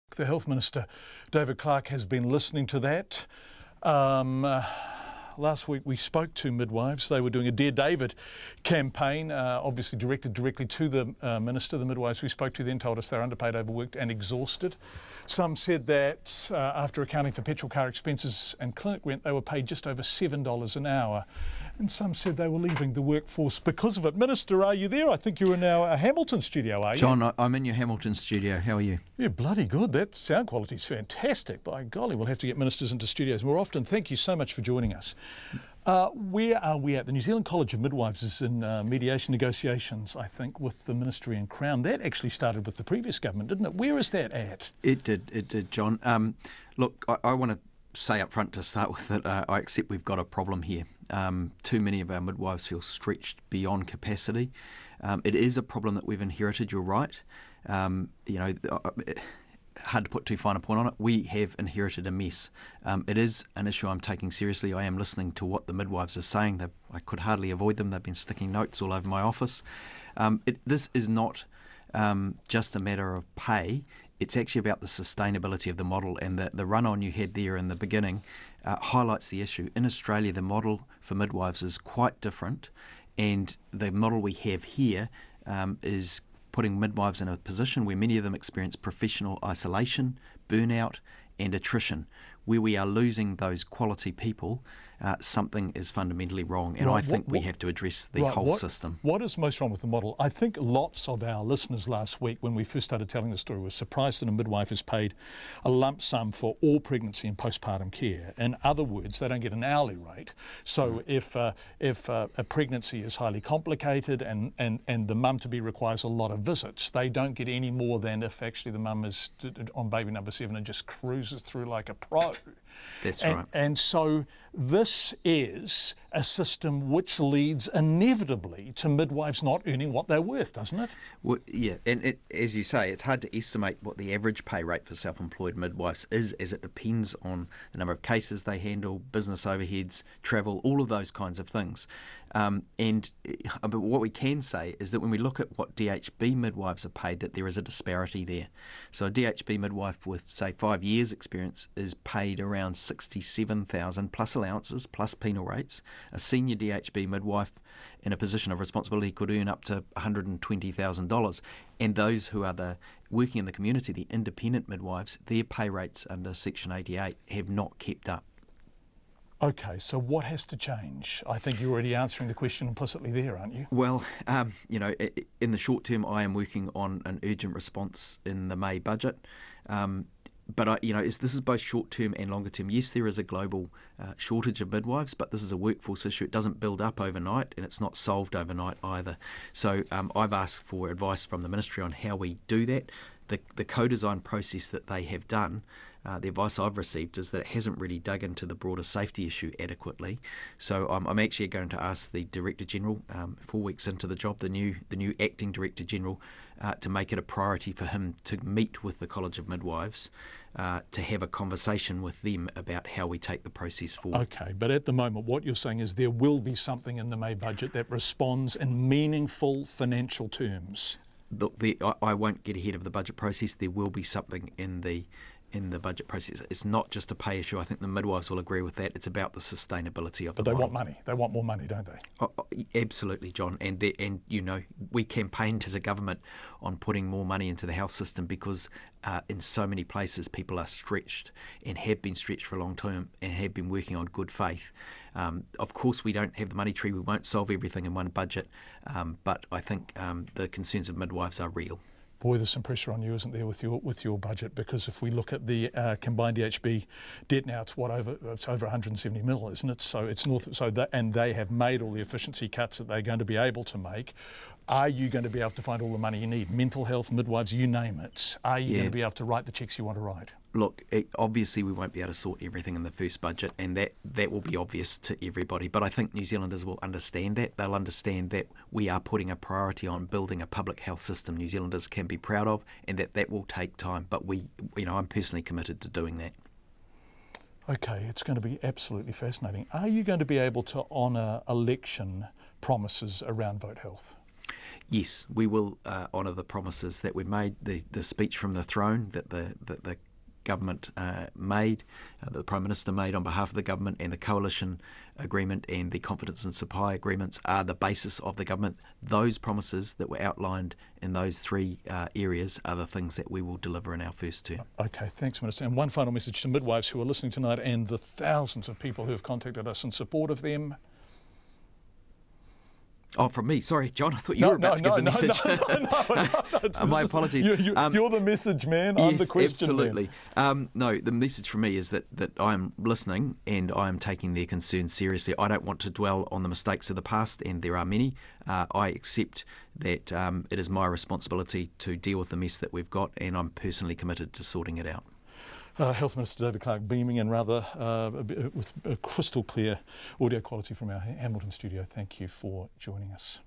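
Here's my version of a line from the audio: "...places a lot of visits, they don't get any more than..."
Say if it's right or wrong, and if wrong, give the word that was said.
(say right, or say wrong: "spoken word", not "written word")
wrong: "requires", not "places".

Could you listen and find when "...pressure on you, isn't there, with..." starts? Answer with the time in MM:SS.
04:12.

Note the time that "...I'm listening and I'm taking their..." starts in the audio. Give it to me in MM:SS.
05:32.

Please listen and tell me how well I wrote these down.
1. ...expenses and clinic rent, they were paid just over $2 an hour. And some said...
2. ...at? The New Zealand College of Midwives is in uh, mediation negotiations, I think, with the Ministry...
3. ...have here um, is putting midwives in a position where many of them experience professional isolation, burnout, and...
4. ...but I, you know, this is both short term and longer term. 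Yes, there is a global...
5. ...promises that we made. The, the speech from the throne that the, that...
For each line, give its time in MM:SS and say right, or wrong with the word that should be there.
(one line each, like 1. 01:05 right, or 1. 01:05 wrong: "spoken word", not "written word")
1. 00:17 wrong: "7", not "2"
2. 00:36 right
3. 01:24 right
4. 03:00 right
5. 04:56 right.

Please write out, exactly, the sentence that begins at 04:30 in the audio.
Look, it, obviously we won't be able to sort everything in the first budget, and that that will be obvious to everybody.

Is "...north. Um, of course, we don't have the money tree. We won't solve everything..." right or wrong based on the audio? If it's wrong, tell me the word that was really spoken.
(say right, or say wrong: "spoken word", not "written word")
wrong: "faith", not "north".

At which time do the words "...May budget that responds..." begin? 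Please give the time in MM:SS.
03:37.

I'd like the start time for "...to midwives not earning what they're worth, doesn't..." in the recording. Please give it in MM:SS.
02:08.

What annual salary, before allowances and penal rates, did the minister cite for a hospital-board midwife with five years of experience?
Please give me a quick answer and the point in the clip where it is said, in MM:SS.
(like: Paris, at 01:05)
$67,000, at 02:32.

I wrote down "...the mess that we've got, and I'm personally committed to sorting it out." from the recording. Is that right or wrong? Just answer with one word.
right.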